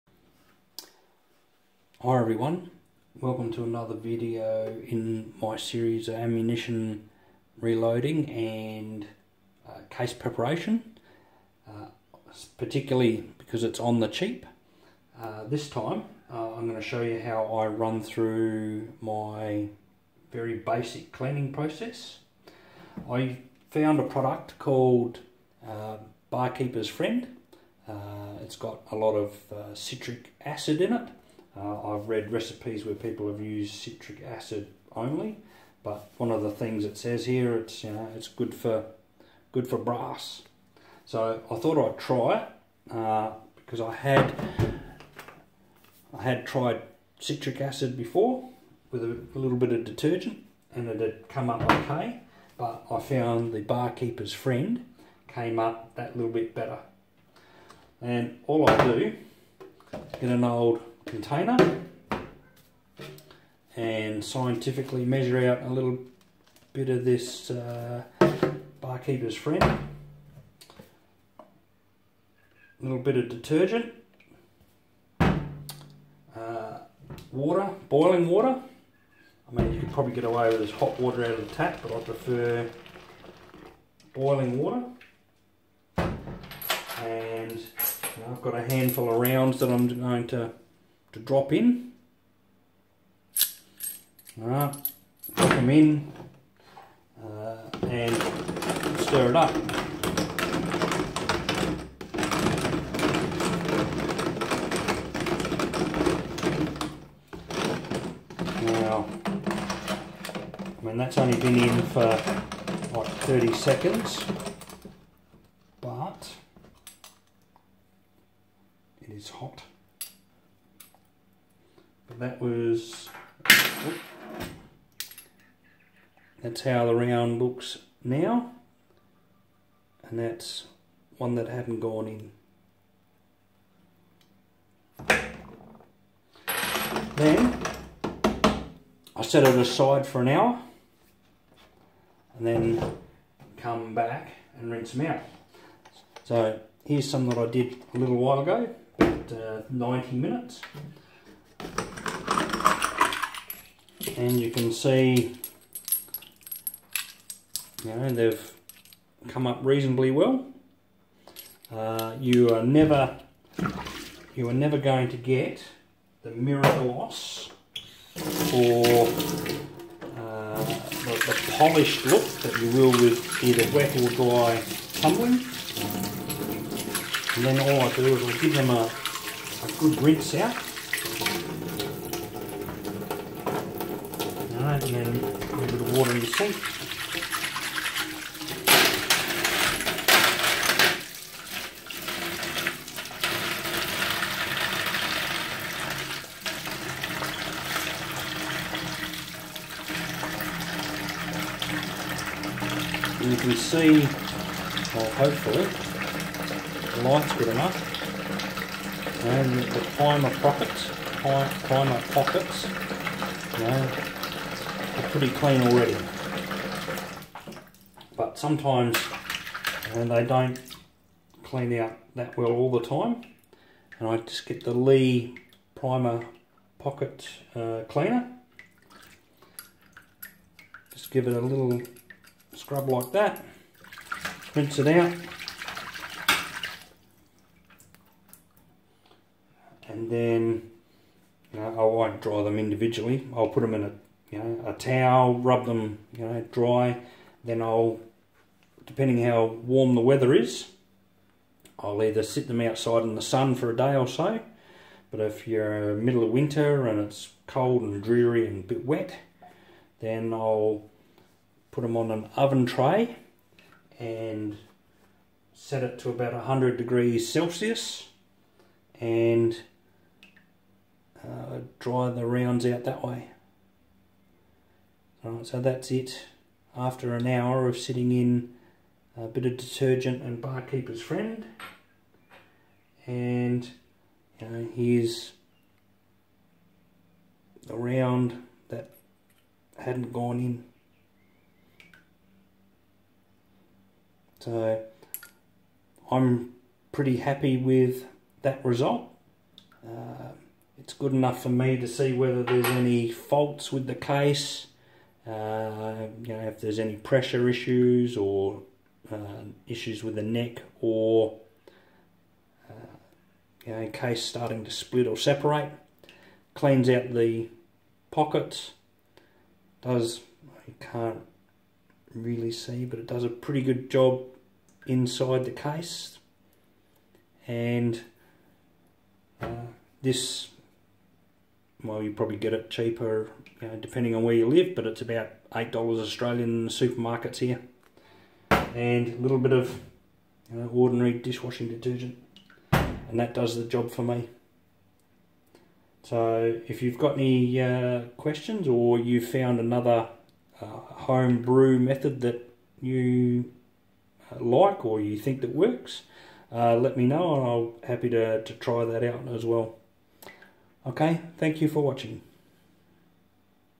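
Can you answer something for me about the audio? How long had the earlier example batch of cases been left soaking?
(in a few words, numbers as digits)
about 90 minutes.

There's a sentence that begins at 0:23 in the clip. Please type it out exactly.
I found a product called uh, Bar Keepers Friend.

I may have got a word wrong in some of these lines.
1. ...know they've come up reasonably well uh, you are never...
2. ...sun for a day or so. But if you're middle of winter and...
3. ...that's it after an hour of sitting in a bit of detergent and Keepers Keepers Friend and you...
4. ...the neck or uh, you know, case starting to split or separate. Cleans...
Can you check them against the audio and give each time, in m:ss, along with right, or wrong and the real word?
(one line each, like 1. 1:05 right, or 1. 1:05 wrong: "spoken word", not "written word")
1. 2:37 right
2. 4:13 right
3. 4:35 wrong: "Bar", not "Keepers"
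4. 5:10 right.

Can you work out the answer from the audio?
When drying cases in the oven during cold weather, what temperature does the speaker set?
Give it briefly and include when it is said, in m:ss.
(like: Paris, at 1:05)
100 degrees Celsius, at 4:26.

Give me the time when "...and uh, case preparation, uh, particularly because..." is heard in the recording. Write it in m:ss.
0:08.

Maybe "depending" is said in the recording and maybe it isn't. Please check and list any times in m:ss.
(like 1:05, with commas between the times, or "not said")
4:08, 5:33.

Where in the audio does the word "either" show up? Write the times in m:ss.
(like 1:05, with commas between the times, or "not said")
2:53, 4:12.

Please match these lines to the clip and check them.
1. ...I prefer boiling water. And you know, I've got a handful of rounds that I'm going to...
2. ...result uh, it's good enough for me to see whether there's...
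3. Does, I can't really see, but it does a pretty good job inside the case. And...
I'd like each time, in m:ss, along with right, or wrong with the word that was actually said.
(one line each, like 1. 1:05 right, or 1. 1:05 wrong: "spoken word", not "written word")
1. 1:21 right
2. 4:58 right
3. 5:19 right.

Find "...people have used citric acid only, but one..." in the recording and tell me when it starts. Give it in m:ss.
0:32.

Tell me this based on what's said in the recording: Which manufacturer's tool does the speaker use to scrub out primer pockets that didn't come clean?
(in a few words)
Lee.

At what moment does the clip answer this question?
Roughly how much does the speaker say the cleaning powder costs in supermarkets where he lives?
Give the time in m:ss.
5:35.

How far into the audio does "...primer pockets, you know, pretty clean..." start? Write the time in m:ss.
3:31.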